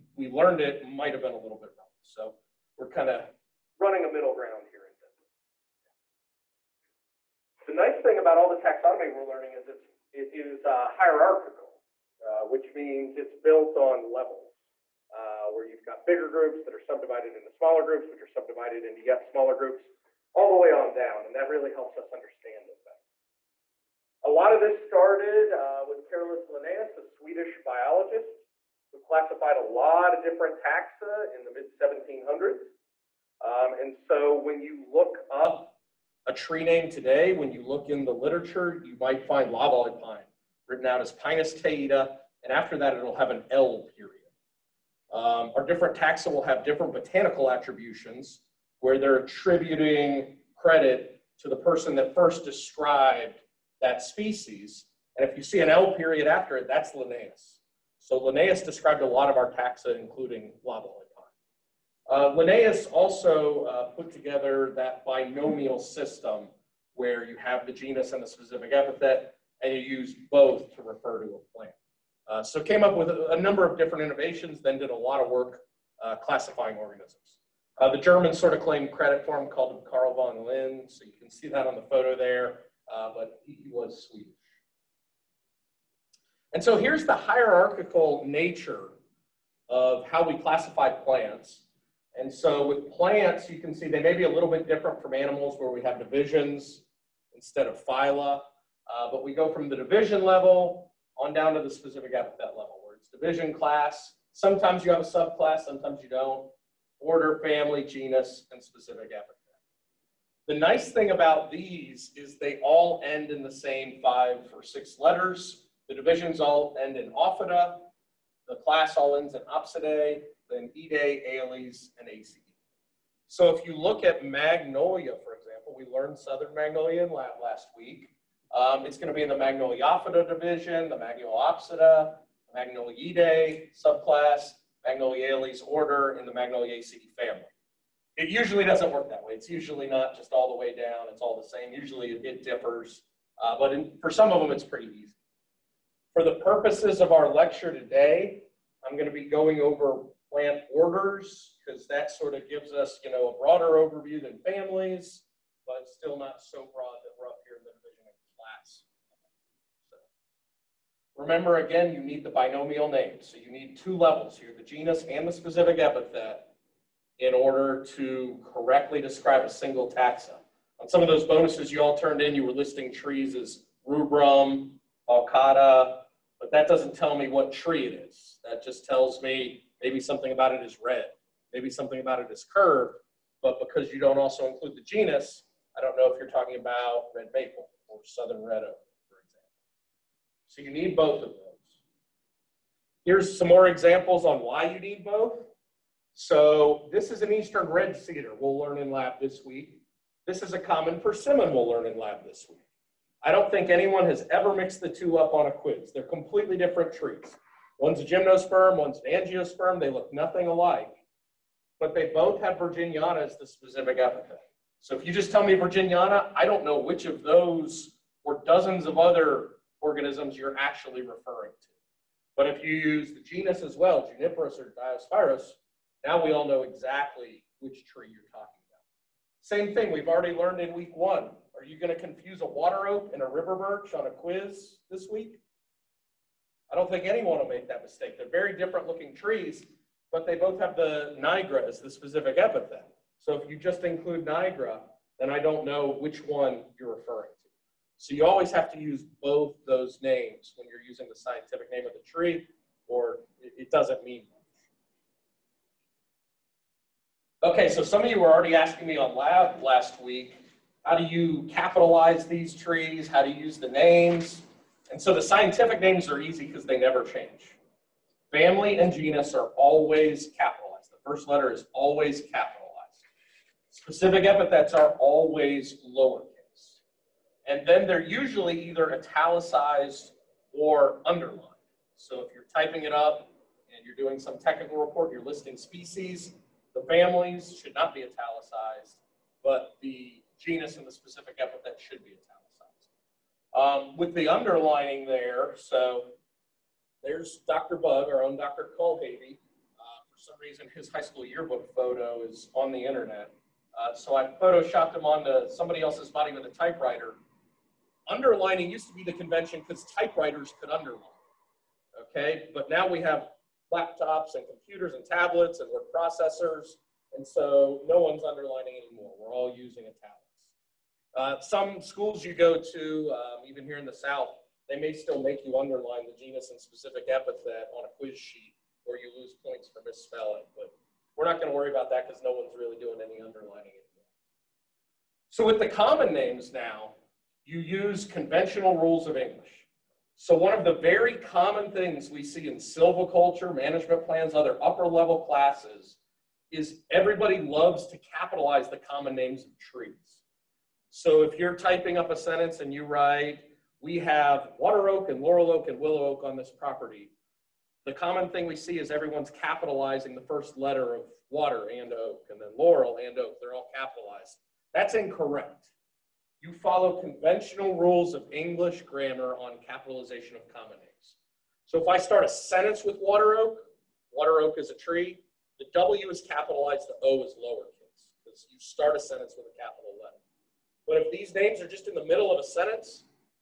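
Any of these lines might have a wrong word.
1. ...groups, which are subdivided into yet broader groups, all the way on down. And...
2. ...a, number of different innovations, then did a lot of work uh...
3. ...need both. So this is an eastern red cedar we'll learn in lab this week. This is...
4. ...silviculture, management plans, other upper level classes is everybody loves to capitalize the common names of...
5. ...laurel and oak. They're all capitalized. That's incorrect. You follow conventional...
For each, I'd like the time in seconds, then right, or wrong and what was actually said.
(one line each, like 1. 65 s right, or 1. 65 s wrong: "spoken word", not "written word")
1. 17 s wrong: "smaller", not "broader"
2. 73 s right
3. 194 s right
4. 342 s right
5. 362 s right.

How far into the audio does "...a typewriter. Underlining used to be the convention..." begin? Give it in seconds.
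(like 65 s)
306 s.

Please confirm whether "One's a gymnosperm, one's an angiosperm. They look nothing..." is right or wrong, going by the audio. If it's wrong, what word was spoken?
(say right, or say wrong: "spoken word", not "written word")
right.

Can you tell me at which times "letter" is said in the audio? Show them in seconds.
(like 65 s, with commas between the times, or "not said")
114 s, 271 s, 360 s.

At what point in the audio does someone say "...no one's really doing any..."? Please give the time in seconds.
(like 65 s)
332 s.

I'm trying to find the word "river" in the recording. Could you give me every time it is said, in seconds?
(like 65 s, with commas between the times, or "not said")
233 s.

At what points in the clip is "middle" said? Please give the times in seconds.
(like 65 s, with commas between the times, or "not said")
4 s, 382 s.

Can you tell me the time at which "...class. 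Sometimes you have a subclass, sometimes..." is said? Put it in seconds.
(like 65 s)
103 s.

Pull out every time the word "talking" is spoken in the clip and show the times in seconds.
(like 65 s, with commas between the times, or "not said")
186 s, 228 s.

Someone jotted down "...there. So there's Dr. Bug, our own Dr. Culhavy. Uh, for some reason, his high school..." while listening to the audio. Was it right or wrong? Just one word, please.
right.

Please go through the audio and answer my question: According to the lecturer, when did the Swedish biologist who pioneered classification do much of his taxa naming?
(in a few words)
mid 1700s.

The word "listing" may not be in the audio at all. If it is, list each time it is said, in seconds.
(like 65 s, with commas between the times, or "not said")
172 s, 285 s.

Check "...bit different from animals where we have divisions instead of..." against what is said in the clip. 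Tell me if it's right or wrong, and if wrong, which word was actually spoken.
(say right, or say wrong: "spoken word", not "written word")
right.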